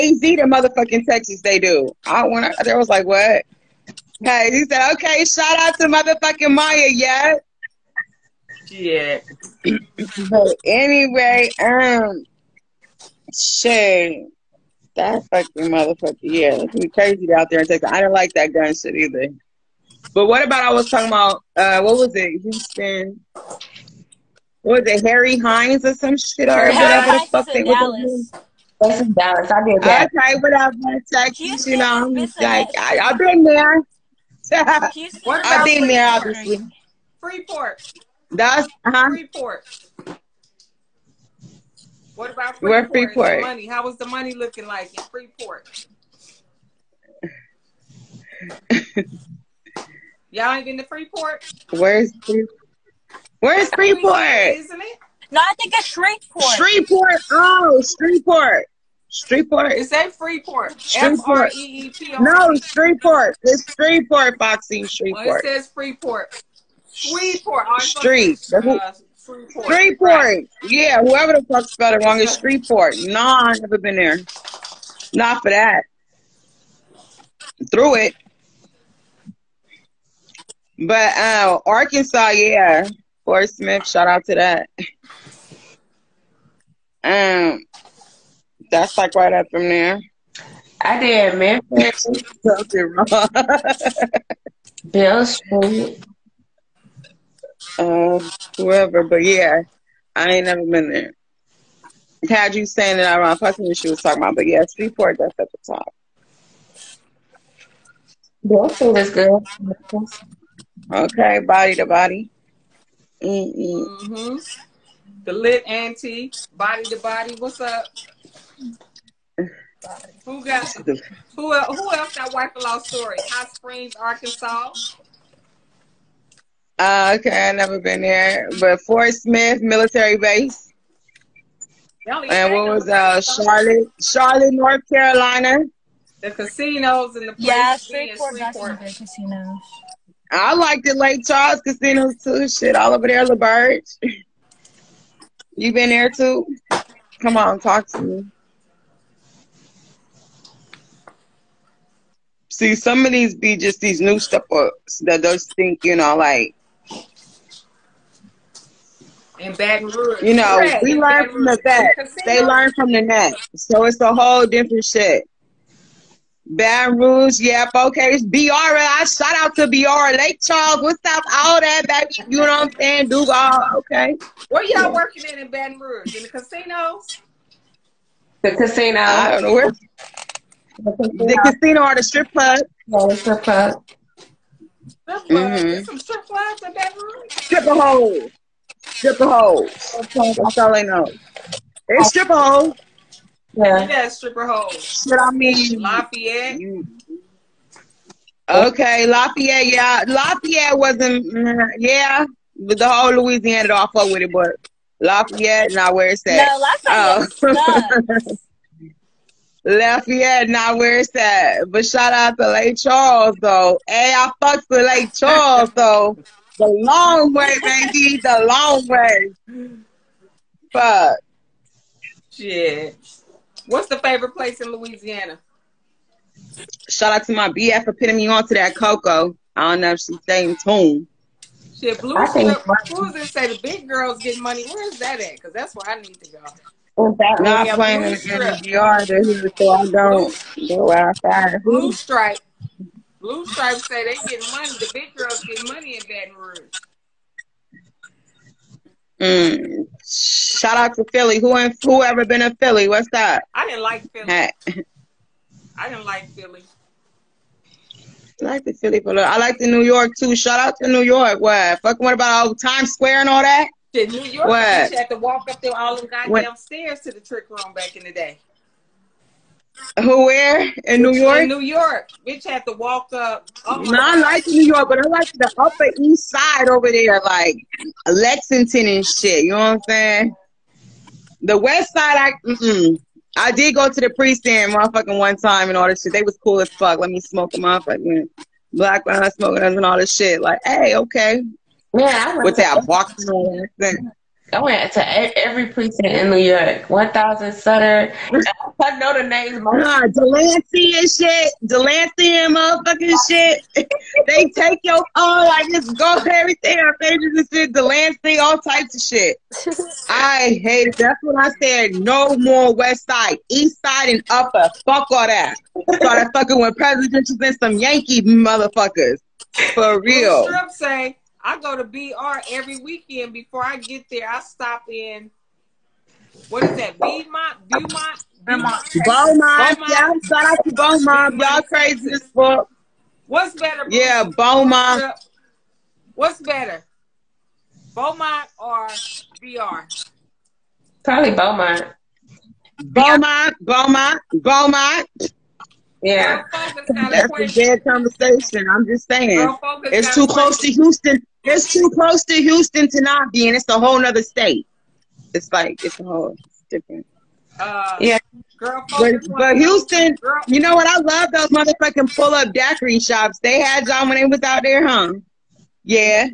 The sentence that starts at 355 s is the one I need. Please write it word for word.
It's like, it's a whole it's different.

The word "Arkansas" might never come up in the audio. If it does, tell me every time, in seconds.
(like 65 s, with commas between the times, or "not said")
81 s, 123 s.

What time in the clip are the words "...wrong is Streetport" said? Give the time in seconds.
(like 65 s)
72 s.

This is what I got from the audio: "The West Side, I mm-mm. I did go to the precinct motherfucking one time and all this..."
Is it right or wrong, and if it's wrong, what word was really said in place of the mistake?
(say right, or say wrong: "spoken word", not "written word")
right.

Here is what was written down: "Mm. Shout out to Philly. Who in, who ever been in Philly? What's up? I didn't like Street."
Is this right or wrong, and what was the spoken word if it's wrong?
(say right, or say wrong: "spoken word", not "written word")
wrong: "Philly", not "Street".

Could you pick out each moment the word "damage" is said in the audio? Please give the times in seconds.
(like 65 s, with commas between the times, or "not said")
not said.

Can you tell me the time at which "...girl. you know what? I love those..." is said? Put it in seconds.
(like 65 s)
360 s.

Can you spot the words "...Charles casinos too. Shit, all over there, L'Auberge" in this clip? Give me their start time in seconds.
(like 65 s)
141 s.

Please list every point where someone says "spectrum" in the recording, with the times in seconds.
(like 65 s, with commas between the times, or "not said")
not said.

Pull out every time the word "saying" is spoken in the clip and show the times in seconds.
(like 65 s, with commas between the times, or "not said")
172 s, 279 s, 349 s.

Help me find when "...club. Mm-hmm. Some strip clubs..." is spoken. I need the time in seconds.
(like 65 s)
185 s.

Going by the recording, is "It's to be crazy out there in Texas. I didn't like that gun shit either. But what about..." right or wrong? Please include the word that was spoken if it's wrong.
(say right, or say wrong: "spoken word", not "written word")
right.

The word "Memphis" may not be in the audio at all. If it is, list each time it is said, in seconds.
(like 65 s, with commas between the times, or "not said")
91 s.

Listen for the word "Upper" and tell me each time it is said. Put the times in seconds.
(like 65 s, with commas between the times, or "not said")
275 s, 314 s.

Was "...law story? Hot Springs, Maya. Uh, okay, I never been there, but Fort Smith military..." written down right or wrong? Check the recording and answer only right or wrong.
wrong.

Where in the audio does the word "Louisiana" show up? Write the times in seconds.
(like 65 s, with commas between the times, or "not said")
203 s, 224 s.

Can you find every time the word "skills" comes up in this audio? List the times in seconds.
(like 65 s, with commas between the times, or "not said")
not said.